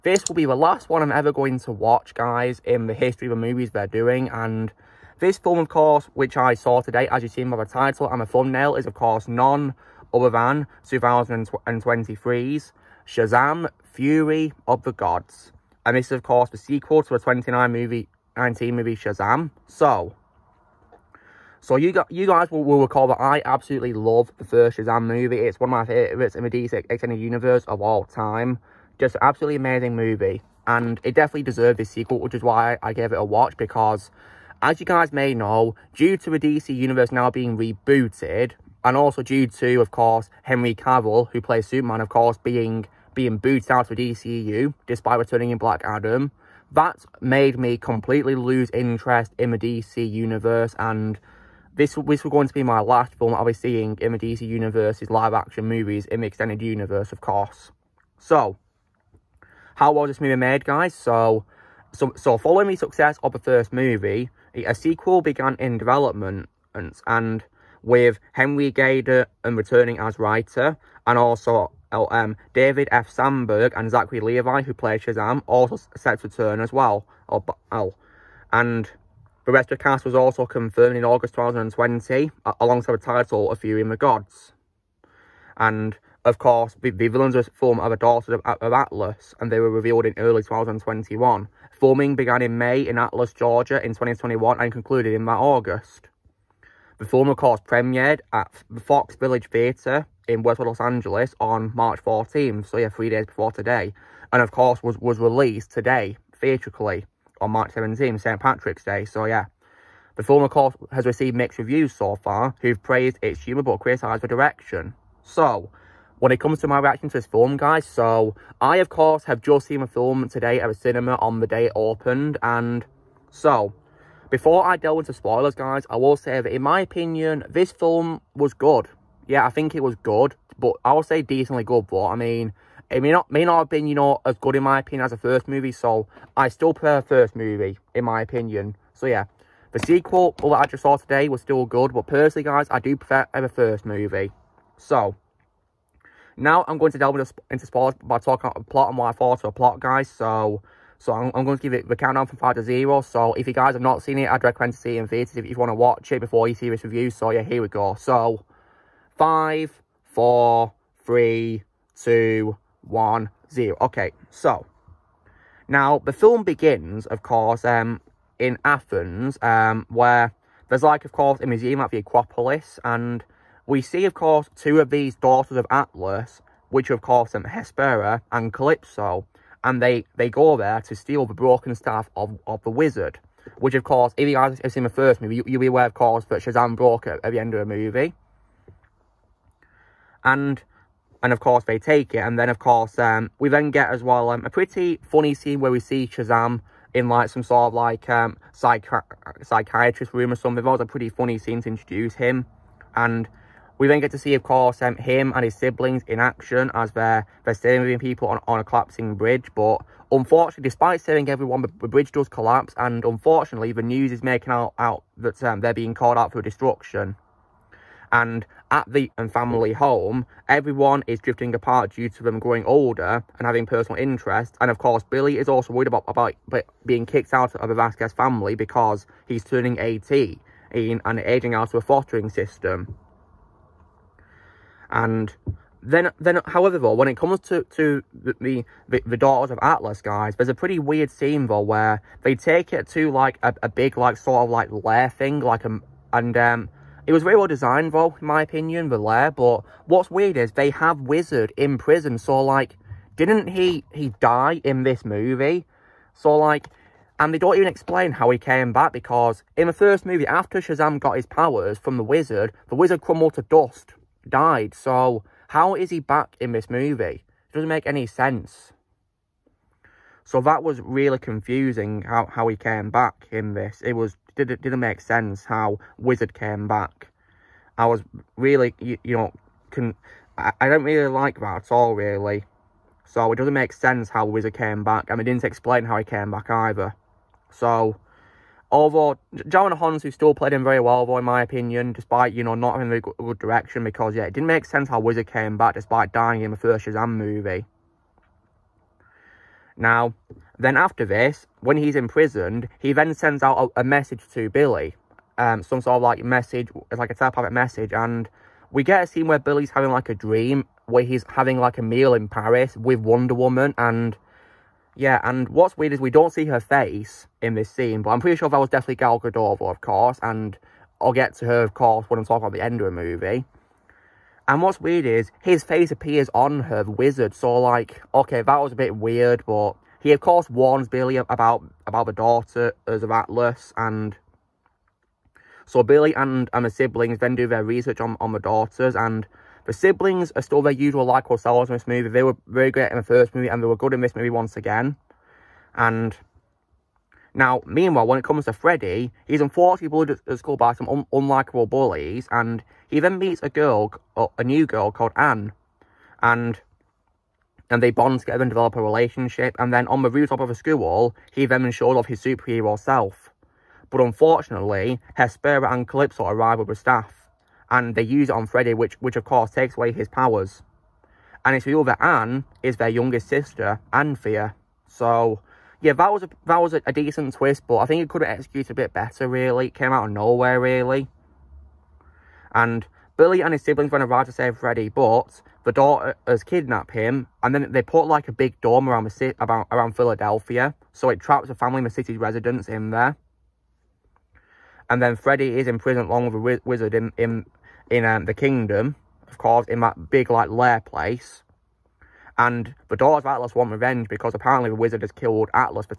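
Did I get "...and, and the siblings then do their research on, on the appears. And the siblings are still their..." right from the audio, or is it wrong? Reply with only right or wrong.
wrong.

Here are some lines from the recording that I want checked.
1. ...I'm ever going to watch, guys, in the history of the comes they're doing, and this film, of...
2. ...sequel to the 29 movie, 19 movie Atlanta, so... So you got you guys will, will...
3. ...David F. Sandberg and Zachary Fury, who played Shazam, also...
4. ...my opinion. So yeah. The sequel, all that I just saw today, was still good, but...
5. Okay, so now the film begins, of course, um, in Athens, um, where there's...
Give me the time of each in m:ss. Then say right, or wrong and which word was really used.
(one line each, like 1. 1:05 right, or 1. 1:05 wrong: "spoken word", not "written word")
1. 0:01 wrong: "movies", not "comes"
2. 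0:16 wrong: "Shazam", not "Atlanta"
3. 1:12 wrong: "Levi", not "Fury"
4. 2:18 right
5. 2:43 right.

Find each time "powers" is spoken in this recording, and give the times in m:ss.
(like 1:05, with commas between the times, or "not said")
4:21, 6:10.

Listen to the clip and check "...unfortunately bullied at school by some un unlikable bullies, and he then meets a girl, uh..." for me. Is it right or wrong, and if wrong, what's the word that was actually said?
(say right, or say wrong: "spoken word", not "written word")
right.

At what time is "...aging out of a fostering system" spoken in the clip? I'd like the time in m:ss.
3:51.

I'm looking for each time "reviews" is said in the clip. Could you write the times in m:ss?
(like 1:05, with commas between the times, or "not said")
1:51, 2:36.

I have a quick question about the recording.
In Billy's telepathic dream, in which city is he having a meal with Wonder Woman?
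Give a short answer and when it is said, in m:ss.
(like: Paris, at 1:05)
Paris, at 5:12.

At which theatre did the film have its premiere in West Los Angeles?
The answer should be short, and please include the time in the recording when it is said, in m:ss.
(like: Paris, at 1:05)
Fox Village Theatre, at 1:38.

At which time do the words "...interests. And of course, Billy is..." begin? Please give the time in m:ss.
3:44.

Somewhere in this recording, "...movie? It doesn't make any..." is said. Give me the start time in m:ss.
4:26.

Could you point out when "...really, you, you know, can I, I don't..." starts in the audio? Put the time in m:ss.
4:38.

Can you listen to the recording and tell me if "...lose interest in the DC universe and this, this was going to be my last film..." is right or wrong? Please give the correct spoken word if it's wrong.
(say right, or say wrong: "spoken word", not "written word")
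right.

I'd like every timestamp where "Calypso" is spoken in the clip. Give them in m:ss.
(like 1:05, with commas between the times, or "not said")
2:58, 6:05.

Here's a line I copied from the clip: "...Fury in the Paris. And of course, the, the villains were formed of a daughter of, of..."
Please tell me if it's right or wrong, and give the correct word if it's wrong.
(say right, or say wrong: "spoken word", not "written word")
wrong: "Gods", not "Paris".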